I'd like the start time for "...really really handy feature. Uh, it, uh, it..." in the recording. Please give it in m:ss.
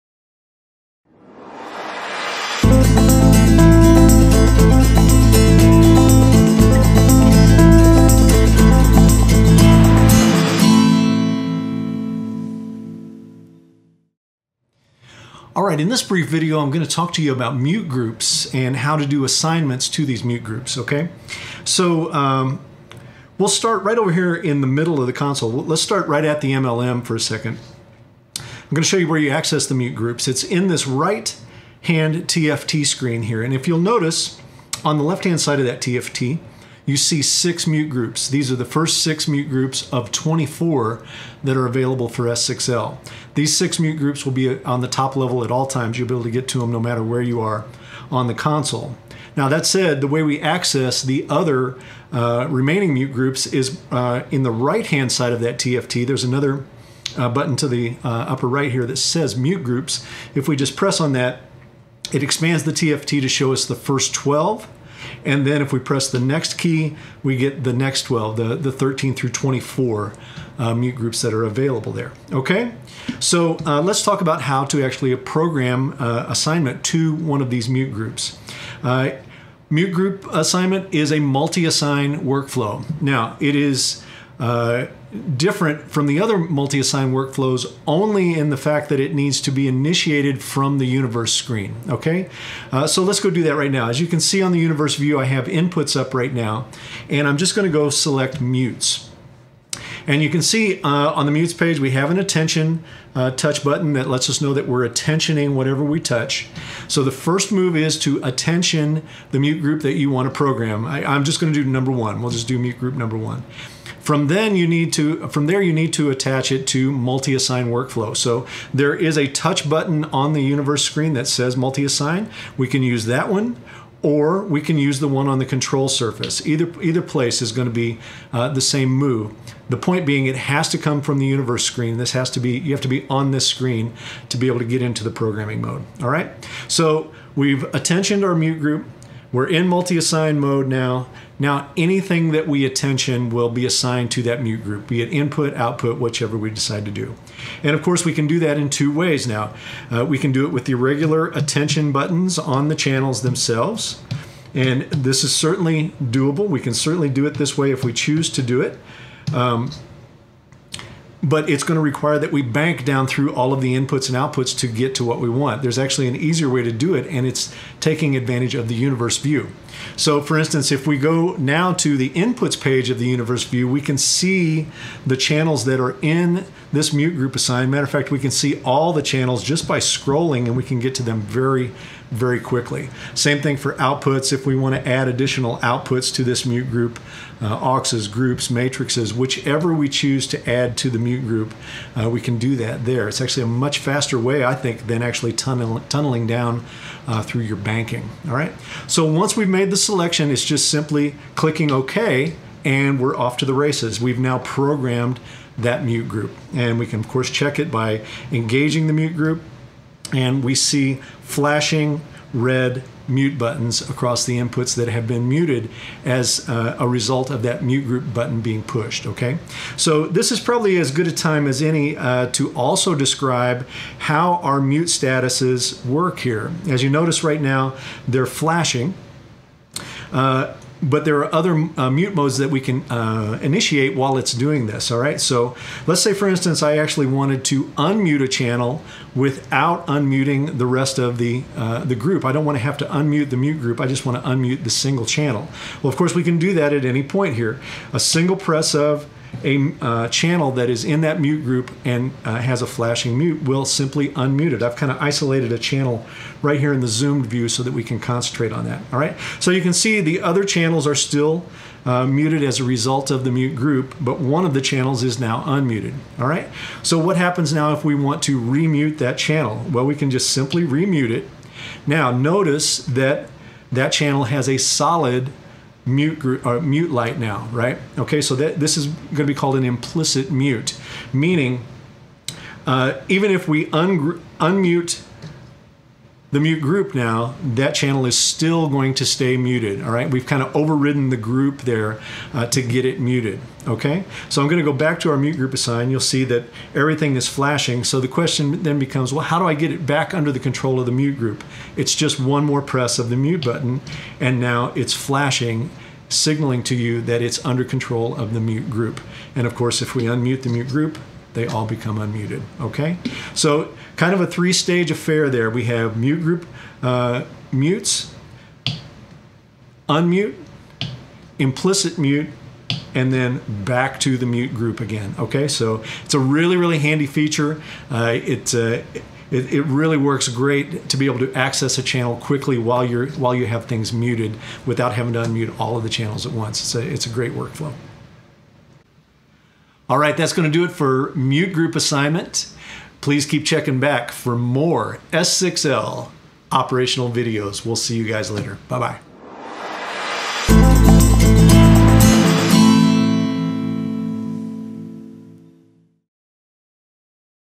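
5:26.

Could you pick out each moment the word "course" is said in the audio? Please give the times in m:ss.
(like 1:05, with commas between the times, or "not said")
2:27, 3:27, 4:05, 5:09.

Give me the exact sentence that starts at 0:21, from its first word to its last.
So um, we'll start right over here in the middle of the console.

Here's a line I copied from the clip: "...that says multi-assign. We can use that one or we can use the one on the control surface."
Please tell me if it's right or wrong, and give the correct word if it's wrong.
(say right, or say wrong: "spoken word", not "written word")
right.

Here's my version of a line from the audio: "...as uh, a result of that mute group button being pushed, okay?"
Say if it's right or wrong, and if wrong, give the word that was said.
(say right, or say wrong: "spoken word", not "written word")
right.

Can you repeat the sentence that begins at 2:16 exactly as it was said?
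So we've attentioned our mute group.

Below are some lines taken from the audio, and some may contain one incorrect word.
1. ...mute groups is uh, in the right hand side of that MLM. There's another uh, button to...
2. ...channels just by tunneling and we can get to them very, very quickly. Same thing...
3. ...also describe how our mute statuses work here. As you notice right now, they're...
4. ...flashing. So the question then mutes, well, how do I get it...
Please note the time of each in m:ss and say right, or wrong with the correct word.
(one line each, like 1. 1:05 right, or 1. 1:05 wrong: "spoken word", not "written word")
1. 0:52 wrong: "TFT", not "MLM"
2. 2:59 wrong: "scrolling", not "tunneling"
3. 3:42 right
4. 4:57 wrong: "becomes", not "mutes".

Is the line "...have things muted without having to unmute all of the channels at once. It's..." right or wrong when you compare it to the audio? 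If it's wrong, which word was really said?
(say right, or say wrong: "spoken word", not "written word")
right.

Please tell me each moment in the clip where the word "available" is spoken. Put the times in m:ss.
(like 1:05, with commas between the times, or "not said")
0:41, 1:11.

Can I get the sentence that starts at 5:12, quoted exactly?
Okay, so kind of a three-stage affair there.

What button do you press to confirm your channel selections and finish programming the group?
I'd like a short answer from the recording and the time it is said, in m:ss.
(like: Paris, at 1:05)
OK, at 3:21.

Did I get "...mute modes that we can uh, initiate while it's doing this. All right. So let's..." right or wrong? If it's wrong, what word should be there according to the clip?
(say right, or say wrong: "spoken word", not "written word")
right.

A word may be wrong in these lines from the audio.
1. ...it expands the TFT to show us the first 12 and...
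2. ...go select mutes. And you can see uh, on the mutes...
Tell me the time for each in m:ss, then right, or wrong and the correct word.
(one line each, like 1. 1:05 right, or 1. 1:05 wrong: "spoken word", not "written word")
1. 1:02 right
2. 1:37 right.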